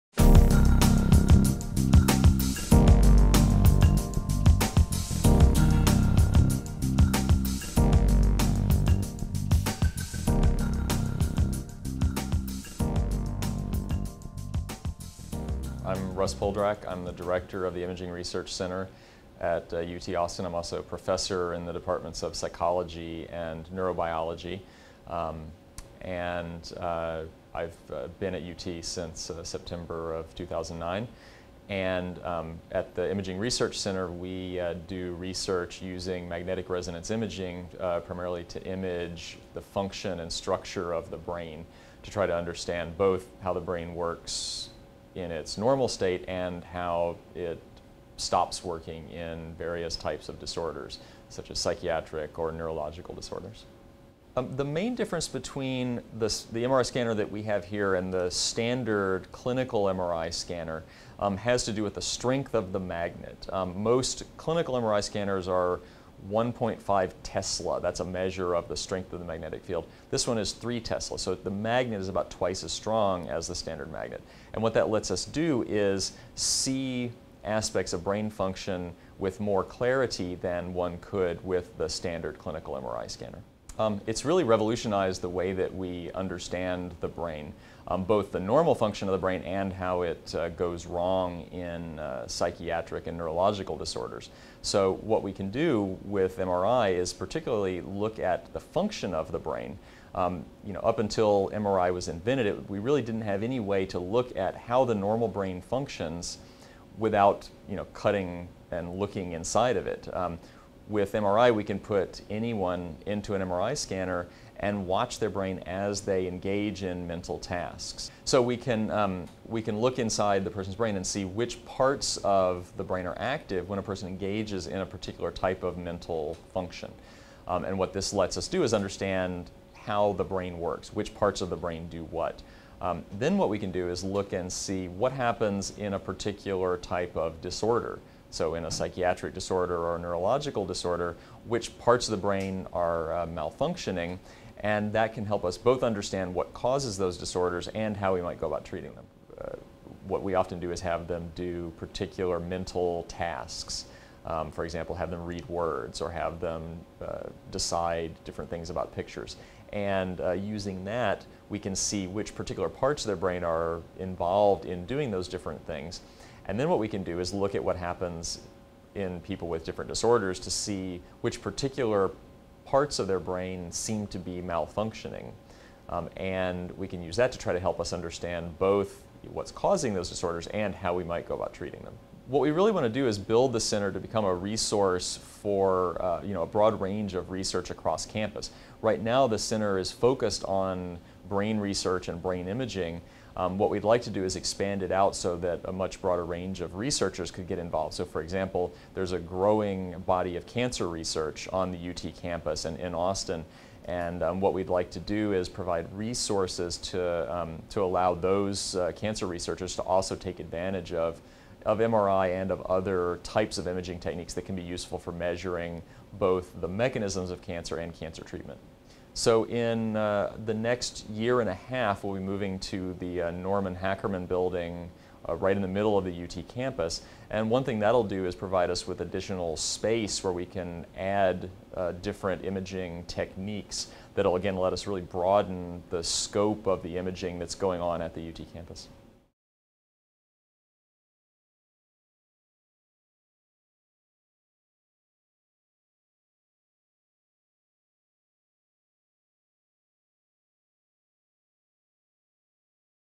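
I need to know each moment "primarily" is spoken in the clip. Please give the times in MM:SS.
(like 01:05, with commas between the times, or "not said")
00:38.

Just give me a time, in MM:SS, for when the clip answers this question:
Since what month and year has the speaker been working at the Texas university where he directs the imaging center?
00:29.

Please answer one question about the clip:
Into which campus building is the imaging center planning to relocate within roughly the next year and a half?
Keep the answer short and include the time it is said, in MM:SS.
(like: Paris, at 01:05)
Norman Hackerman building, at 03:43.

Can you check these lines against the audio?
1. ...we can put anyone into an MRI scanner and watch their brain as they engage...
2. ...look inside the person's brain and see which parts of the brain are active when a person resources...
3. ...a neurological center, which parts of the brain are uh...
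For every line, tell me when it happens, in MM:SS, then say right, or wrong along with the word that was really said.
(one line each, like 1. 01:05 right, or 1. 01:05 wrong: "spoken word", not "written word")
1. 01:51 right
2. 01:59 wrong: "engages", not "resources"
3. 02:19 wrong: "disorder", not "center".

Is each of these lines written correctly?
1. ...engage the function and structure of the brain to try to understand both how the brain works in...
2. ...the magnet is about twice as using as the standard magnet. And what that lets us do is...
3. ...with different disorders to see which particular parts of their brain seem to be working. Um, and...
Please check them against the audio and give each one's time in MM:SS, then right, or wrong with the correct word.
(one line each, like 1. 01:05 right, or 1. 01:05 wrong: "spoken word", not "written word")
1. 00:38 wrong: "image", not "engage"
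2. 01:11 wrong: "strong", not "using"
3. 02:49 wrong: "malfunctioning", not "working".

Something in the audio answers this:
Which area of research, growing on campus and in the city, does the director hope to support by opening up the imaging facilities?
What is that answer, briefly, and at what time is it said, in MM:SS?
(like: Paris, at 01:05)
Cancer research, at 03:20.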